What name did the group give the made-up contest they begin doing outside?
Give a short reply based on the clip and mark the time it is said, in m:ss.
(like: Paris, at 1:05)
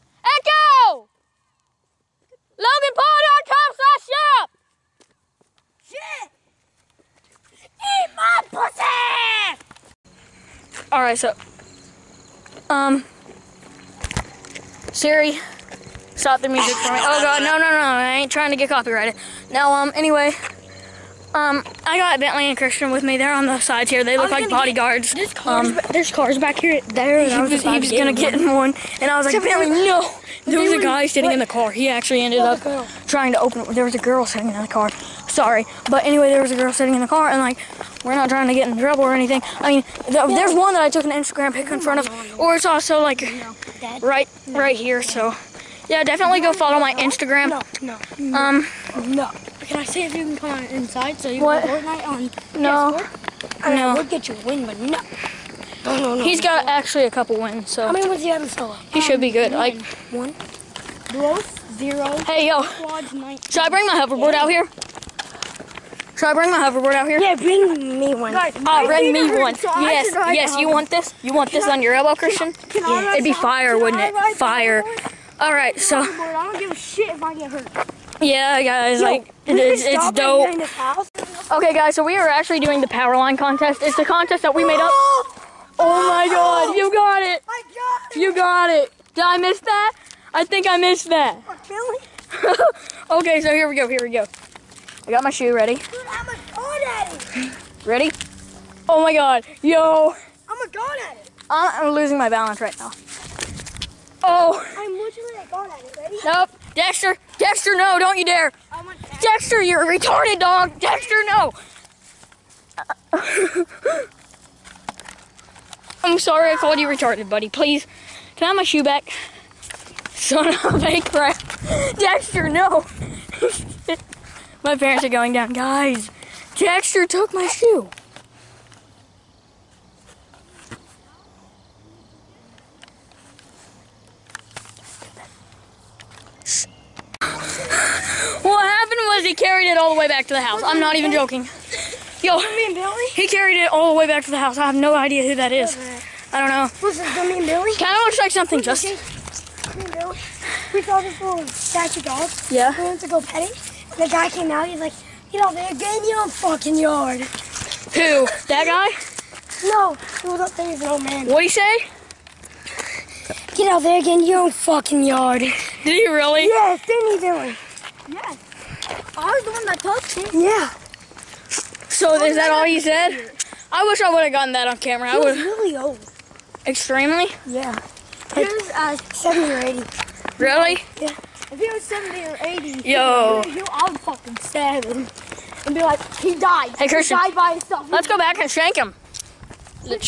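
power line contest, at 1:22.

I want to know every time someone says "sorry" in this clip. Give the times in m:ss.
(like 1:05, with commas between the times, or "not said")
0:35, 1:56.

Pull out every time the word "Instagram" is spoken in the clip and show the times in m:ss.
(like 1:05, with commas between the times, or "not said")
0:41, 0:46.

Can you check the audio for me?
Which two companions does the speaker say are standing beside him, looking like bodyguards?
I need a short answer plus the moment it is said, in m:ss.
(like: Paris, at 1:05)
Bentley and Christian, at 0:22.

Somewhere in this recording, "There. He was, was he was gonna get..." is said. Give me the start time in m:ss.
0:26.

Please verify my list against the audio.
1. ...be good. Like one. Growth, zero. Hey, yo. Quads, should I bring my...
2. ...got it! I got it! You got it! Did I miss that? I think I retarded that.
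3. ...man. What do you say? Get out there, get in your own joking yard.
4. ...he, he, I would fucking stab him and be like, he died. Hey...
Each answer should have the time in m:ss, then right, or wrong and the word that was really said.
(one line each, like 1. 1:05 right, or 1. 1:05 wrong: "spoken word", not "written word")
1. 0:59 right
2. 1:26 wrong: "missed", not "retarded"
3. 2:41 wrong: "fucking", not "joking"
4. 3:03 right.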